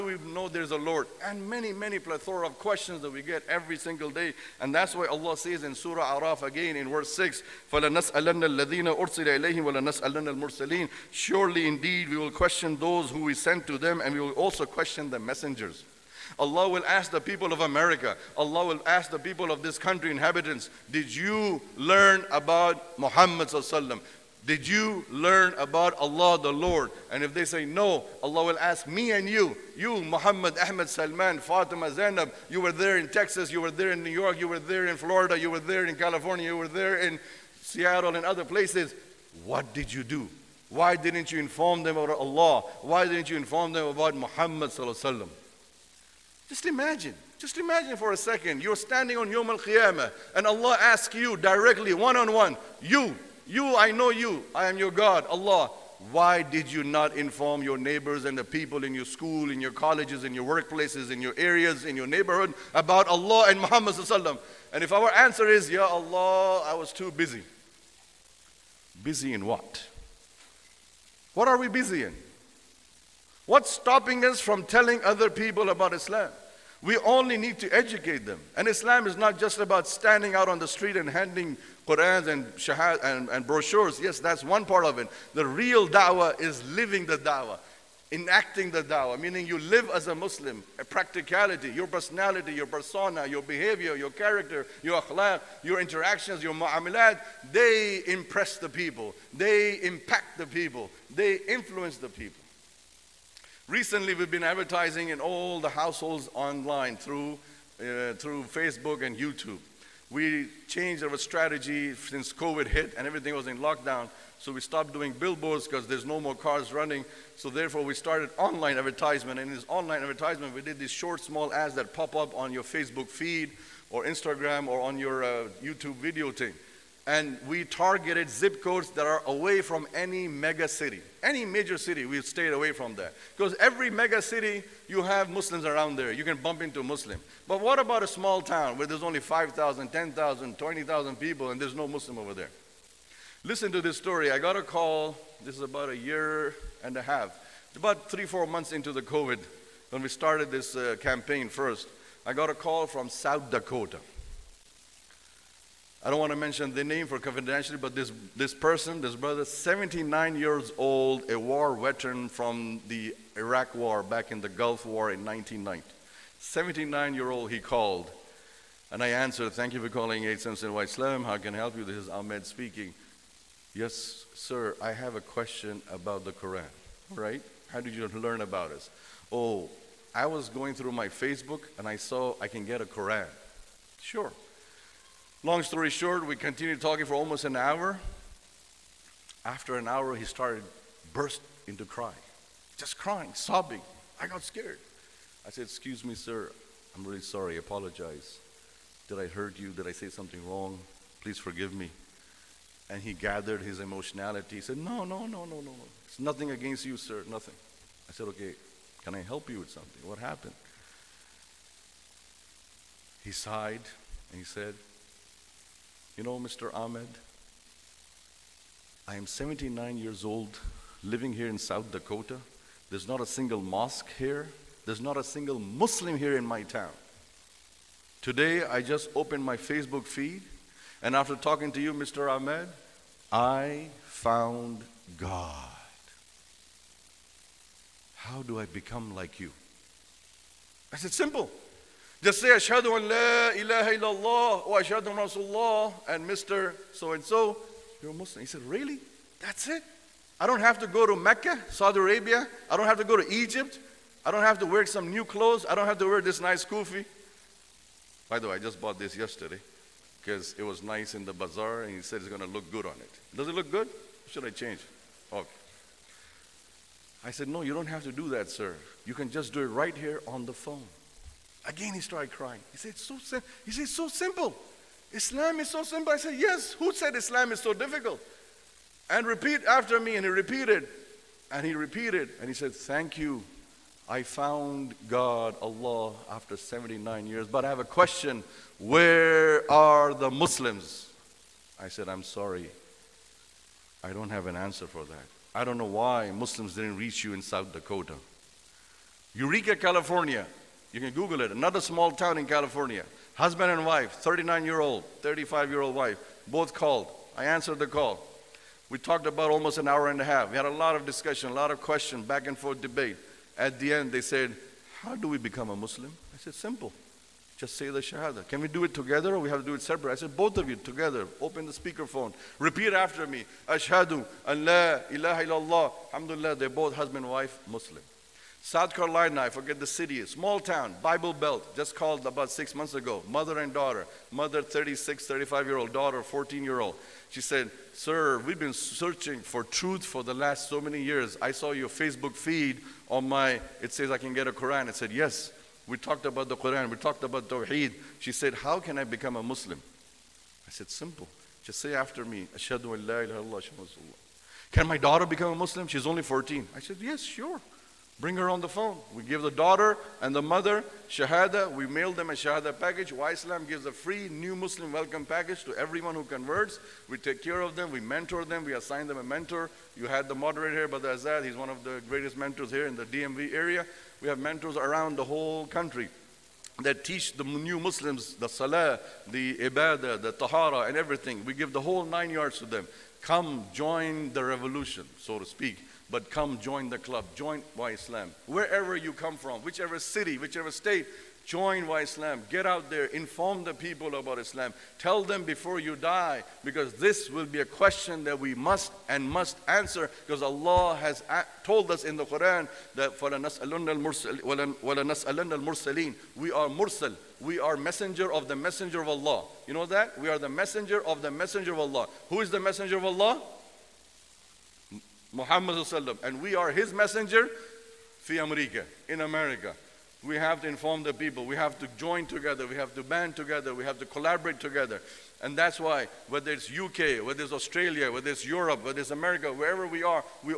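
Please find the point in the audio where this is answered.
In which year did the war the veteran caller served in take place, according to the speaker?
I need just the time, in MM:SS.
02:45.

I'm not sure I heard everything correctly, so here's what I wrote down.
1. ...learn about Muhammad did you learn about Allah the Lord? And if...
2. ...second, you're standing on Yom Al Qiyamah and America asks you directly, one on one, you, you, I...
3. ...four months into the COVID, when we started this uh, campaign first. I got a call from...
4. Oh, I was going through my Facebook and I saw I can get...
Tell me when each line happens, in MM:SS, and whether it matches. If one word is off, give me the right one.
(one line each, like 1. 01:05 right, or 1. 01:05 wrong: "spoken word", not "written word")
1. 00:21 right
2. 00:48 wrong: "Allah", not "America"
3. 02:28 right
4. 02:59 right.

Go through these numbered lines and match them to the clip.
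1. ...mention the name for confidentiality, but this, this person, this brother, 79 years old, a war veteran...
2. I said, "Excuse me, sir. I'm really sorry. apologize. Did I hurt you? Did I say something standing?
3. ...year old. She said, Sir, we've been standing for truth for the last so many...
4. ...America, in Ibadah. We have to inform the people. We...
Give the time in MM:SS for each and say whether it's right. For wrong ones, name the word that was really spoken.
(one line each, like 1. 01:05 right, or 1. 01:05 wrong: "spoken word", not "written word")
1. 02:36 right
2. 03:15 wrong: "wrong", not "standing"
3. 05:36 wrong: "searching", not "standing"
4. 06:58 wrong: "America", not "Ibadah".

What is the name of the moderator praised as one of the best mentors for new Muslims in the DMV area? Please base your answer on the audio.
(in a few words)
Brother Azad.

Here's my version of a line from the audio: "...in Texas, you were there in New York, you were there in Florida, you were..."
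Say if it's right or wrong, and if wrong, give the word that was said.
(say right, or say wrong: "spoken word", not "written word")
right.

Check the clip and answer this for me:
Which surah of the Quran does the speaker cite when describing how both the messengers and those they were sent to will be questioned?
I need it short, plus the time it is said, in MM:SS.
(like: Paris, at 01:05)
Surah Araf, at 00:05.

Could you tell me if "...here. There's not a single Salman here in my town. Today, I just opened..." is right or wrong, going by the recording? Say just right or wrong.
wrong.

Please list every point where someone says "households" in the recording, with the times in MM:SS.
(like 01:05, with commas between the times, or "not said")
01:45.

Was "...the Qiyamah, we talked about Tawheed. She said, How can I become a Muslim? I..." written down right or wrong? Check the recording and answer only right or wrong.
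wrong.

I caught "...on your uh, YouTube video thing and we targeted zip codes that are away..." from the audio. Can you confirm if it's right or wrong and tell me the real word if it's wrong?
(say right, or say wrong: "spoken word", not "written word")
right.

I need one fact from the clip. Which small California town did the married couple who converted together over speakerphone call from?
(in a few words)
Eureka.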